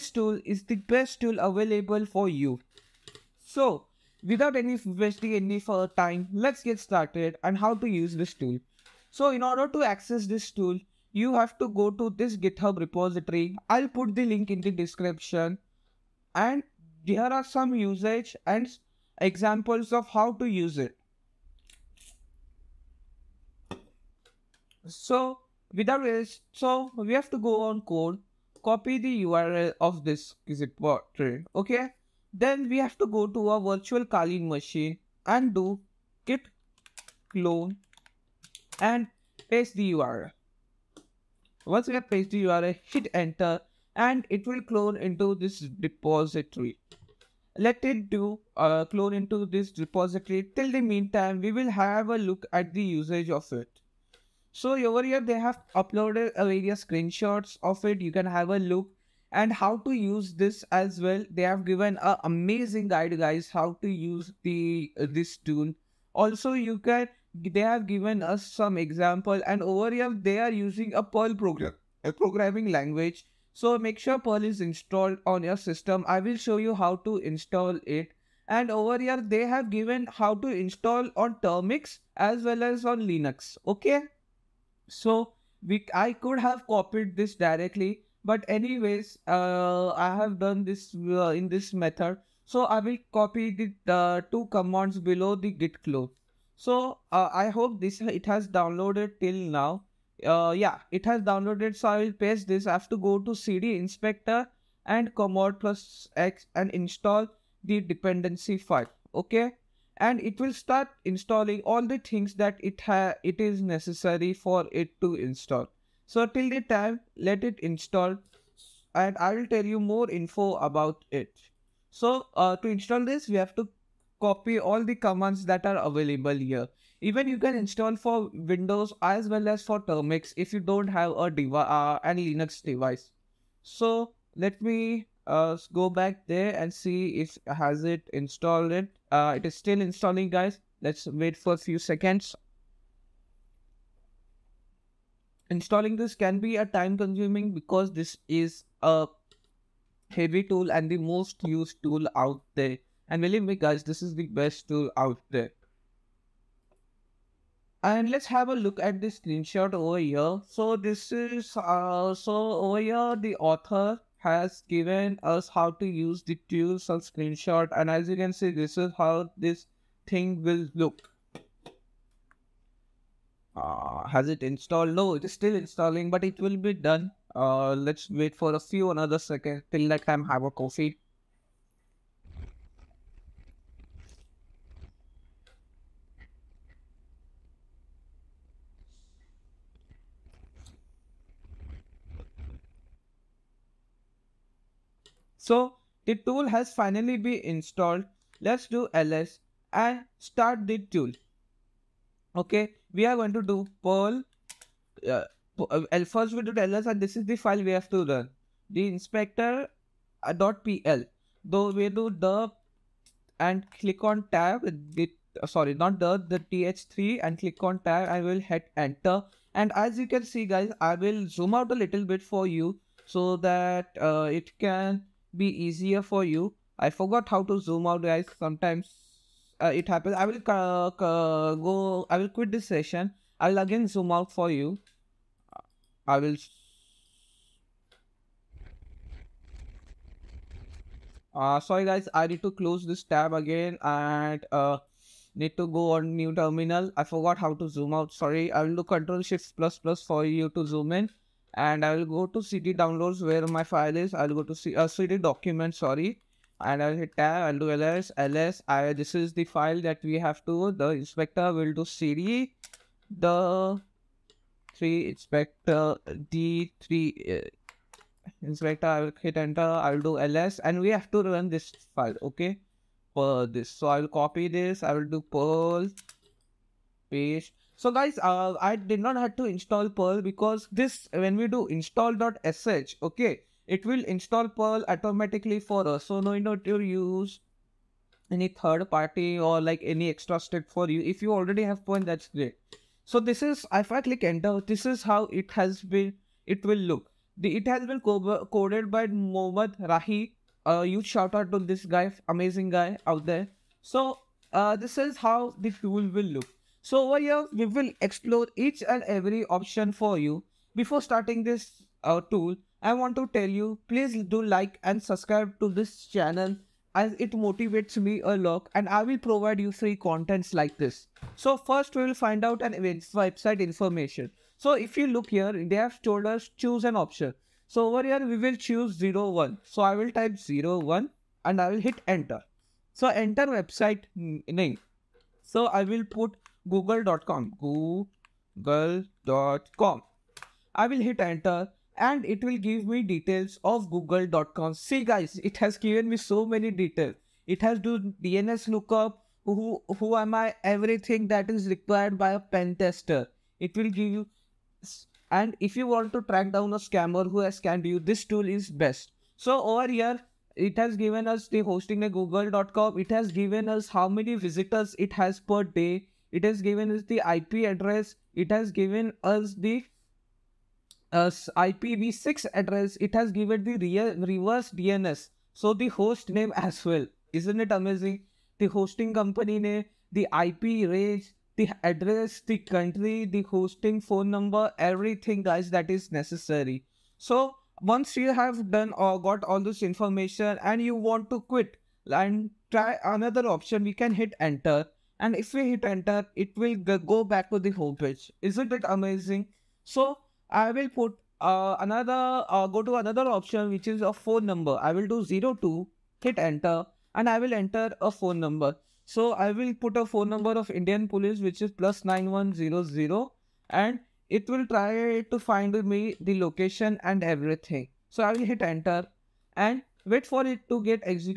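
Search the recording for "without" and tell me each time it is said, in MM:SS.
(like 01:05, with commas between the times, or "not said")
00:04, 00:25.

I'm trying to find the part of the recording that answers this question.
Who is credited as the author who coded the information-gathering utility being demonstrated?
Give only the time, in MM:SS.
04:59.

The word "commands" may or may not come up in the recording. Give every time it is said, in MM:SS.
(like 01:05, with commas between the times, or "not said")
01:34, 01:45, 02:04.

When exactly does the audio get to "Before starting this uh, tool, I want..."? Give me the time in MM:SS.
05:10.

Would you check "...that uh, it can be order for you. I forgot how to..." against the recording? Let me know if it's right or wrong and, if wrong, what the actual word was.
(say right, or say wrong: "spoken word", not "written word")
wrong: "easier", not "order".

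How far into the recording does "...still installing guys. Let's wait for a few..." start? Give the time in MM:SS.
02:19.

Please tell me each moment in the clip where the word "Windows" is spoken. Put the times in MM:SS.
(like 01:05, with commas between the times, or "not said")
02:08.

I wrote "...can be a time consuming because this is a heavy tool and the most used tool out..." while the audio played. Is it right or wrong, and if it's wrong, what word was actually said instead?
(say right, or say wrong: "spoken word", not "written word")
right.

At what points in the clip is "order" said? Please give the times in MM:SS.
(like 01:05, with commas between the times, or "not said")
00:09.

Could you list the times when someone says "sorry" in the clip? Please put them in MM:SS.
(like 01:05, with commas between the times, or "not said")
03:35, 04:01, 04:08, 04:15.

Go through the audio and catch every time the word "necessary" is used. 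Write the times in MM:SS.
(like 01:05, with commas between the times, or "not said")
01:53, 06:26.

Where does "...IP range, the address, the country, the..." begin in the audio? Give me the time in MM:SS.
06:20.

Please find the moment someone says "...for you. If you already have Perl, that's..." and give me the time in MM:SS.
04:50.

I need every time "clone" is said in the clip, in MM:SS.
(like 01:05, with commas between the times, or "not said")
00:37, 00:44, 00:48, 01:35.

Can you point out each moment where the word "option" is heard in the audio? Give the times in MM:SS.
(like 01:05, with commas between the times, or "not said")
05:09, 05:26, 06:33, 06:43.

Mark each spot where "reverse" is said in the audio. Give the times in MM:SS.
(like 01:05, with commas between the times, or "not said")
06:14.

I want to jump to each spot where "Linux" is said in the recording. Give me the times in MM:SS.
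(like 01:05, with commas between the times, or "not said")
01:23, 02:12.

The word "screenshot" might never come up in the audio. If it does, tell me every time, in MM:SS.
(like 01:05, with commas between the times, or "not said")
00:56, 02:39, 02:47.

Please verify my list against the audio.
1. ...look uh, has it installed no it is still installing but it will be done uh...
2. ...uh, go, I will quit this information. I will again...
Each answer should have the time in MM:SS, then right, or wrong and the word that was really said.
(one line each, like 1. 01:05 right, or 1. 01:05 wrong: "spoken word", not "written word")
1. 02:50 right
2. 03:50 wrong: "session", not "information".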